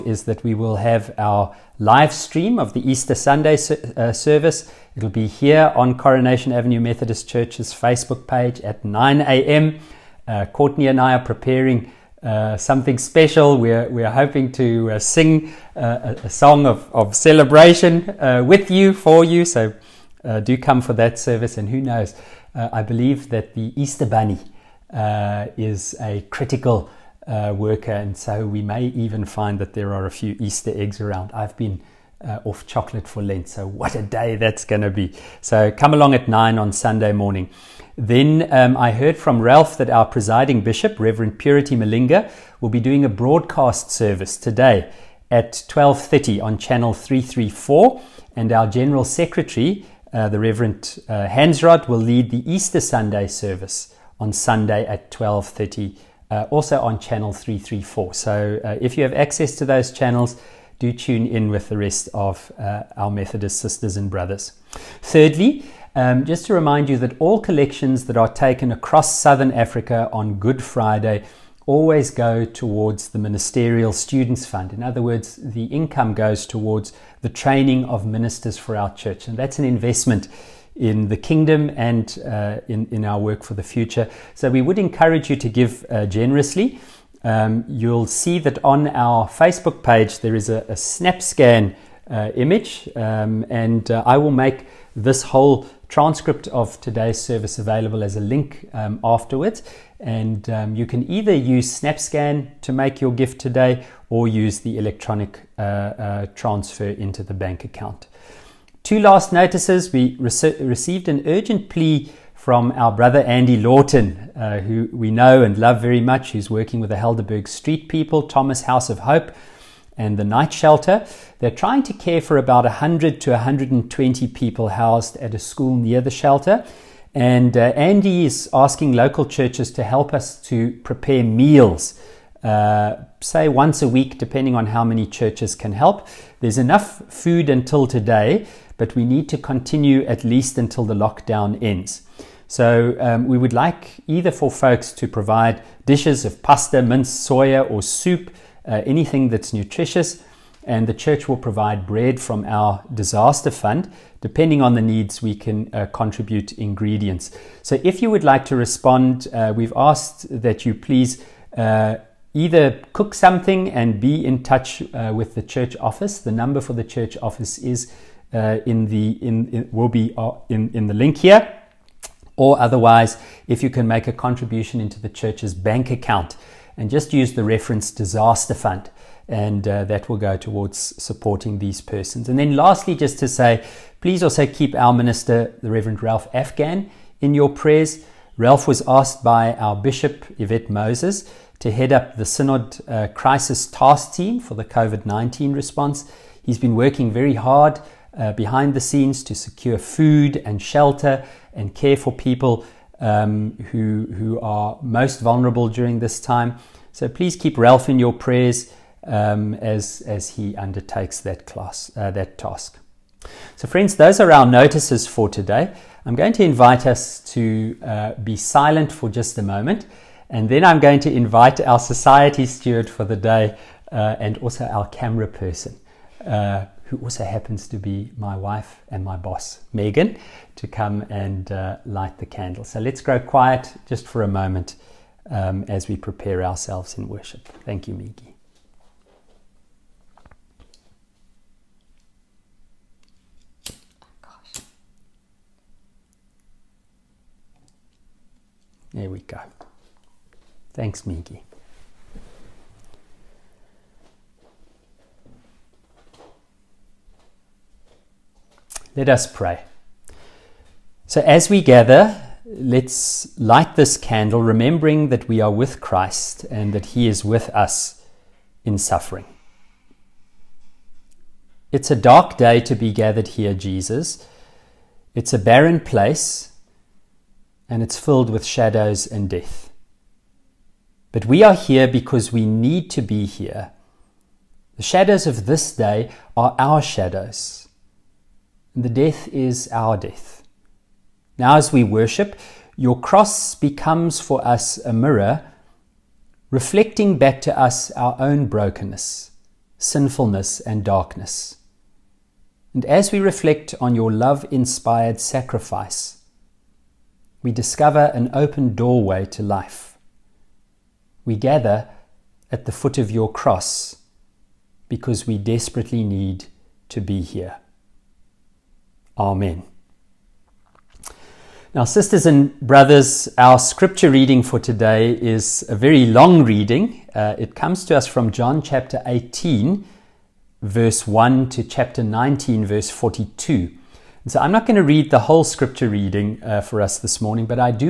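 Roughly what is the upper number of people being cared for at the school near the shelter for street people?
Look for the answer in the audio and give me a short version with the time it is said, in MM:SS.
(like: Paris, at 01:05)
120, at 02:03.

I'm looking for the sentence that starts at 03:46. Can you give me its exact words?
Uh, who also happens to be my wife and my boss, Megan, to come and uh, light the candle.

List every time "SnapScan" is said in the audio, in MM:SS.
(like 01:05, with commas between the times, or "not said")
01:30, 01:41.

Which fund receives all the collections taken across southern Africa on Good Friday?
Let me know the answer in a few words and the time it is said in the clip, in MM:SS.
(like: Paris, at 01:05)
Ministerial Students Fund, at 01:13.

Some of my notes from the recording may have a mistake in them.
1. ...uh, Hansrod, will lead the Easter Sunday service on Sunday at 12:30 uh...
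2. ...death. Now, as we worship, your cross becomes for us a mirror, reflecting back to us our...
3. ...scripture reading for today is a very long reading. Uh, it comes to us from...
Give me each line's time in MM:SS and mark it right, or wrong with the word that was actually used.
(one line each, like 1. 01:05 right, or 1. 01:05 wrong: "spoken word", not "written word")
1. 00:51 right
2. 04:49 right
3. 05:23 right.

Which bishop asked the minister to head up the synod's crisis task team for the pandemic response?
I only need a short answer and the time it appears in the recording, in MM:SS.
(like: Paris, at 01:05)
Yvette Moses, at 03:10.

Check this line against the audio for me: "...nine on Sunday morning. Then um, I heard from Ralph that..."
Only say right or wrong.
right.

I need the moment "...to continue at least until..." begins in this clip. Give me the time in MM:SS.
02:19.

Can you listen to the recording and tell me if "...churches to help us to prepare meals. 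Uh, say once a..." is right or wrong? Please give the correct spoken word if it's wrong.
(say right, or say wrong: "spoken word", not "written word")
right.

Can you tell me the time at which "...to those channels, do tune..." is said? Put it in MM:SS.
00:59.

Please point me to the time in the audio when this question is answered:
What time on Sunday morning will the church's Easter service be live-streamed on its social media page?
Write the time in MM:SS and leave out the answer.
00:08.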